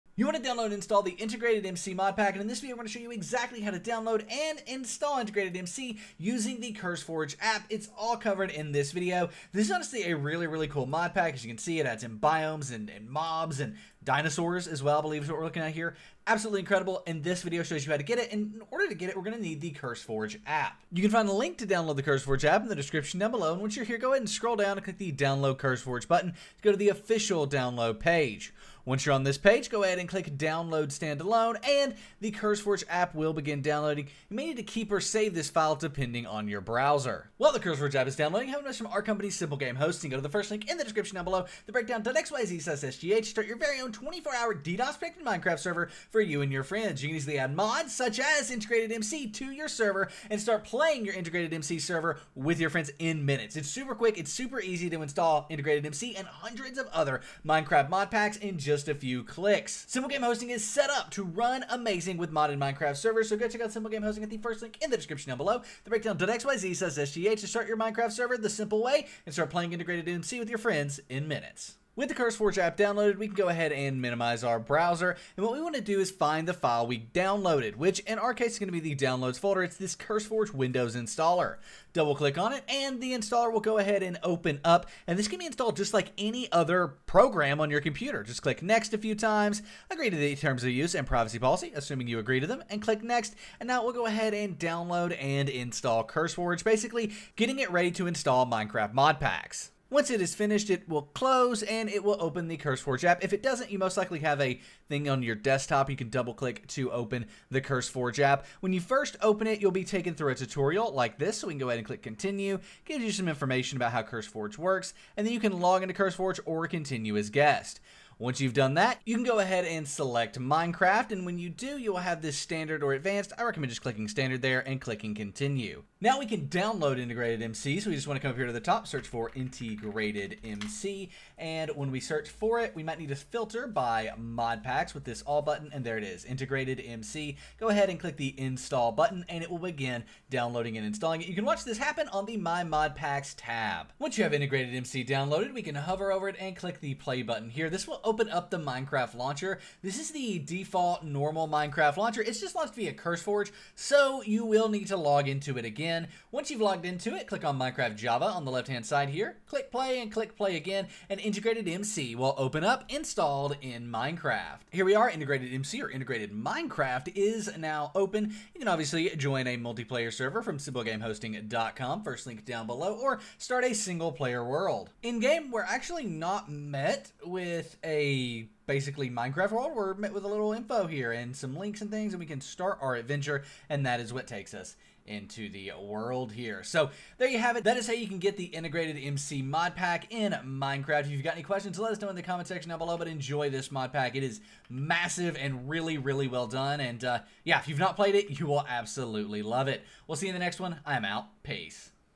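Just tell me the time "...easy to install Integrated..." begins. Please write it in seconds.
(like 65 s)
54 s.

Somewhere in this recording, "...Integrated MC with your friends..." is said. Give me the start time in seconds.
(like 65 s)
69 s.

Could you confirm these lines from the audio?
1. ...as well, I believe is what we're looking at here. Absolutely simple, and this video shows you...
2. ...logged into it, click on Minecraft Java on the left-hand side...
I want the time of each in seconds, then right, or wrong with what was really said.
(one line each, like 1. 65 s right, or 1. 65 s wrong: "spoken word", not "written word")
1. 14 s wrong: "incredible", not "simple"
2. 156 s right.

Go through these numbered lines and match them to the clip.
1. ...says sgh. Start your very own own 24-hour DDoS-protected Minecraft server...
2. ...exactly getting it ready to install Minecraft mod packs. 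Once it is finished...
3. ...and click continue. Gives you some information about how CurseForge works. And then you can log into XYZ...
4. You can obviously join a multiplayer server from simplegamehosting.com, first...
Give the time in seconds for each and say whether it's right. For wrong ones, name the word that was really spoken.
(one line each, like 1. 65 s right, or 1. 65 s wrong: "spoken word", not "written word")
1. 42 s right
2. 96 s wrong: "basically", not "exactly"
3. 111 s wrong: "CurseForge", not "XYZ"
4. 168 s right.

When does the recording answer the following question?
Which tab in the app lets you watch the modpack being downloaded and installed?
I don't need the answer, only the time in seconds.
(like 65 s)
142 s.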